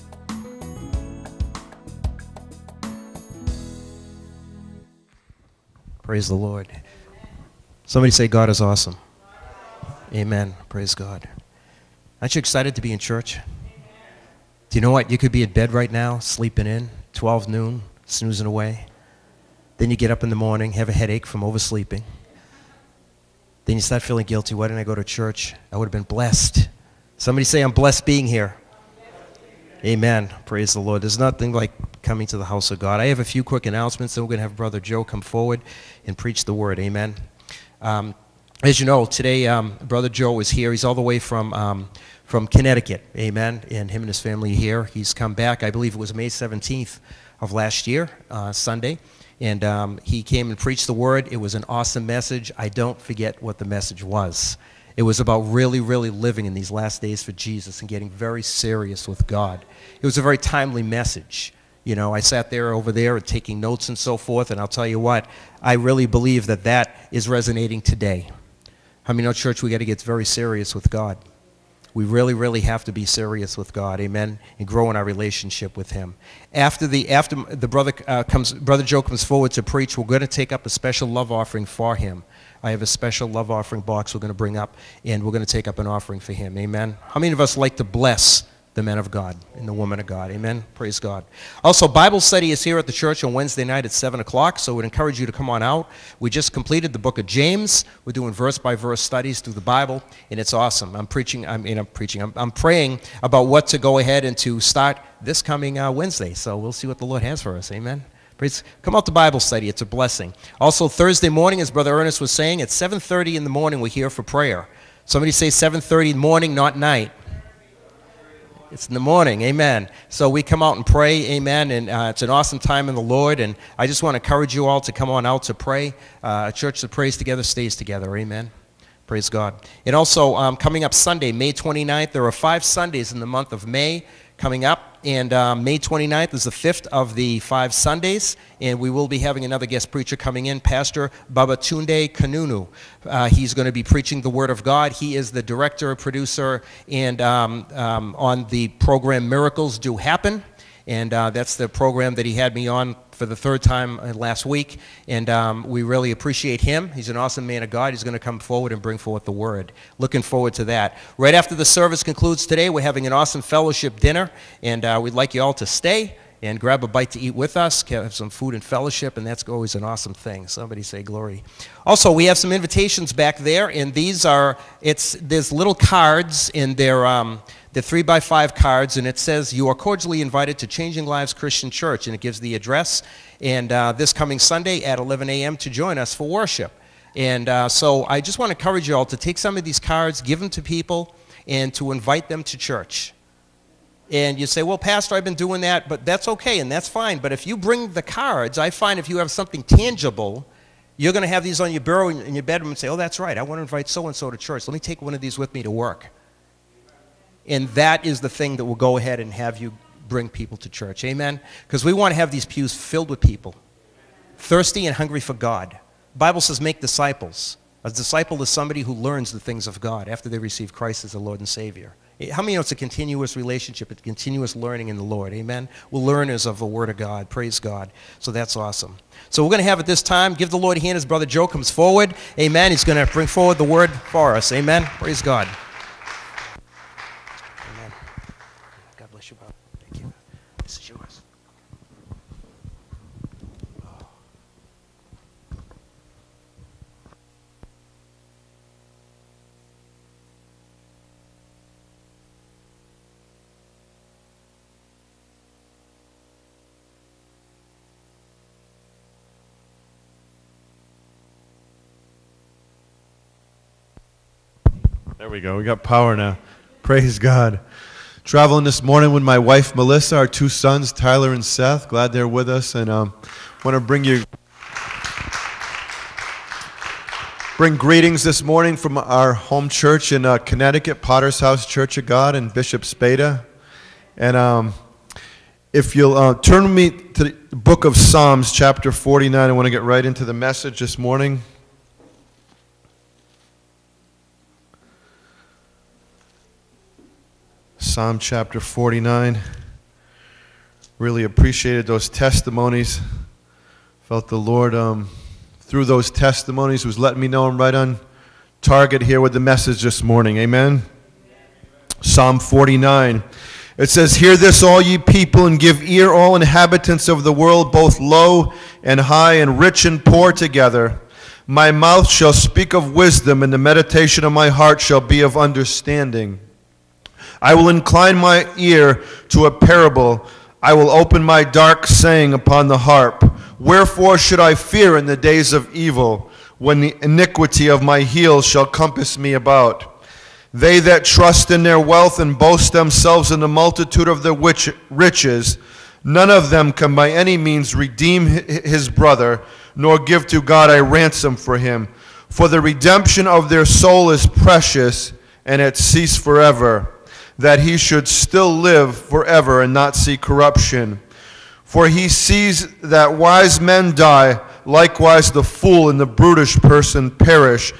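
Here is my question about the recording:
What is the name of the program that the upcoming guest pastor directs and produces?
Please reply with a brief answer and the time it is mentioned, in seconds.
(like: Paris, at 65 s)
Miracles Do Happen, at 149 s.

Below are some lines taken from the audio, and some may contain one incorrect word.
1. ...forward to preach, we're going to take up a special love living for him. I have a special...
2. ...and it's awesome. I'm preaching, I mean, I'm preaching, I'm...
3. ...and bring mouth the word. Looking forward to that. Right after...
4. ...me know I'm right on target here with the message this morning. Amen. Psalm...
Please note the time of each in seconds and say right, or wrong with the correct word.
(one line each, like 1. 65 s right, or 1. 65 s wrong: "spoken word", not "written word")
1. 79 s wrong: "offering", not "living"
2. 100 s right
3. 158 s wrong: "forth", not "mouth"
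4. 307 s right.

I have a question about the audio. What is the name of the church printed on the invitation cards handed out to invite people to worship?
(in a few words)
Changing Lives Christian Church.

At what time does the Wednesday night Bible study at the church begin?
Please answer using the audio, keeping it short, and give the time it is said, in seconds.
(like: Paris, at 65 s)
7 o'clock, at 93 s.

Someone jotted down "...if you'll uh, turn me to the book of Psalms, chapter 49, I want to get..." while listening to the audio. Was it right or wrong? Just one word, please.
right.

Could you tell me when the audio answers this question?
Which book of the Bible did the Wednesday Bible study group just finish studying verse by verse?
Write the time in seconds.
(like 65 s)
97 s.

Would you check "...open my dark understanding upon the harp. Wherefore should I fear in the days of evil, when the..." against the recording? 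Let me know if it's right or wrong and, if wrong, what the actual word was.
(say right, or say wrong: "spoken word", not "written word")
wrong: "saying", not "understanding".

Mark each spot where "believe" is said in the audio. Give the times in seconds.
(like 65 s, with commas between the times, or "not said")
45 s, 66 s.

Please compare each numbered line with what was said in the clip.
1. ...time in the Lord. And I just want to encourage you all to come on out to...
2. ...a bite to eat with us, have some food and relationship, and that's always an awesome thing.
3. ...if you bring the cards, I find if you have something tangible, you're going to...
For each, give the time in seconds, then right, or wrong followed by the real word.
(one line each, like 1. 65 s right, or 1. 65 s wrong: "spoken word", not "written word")
1. 122 s right
2. 166 s wrong: "fellowship", not "relationship"
3. 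197 s right.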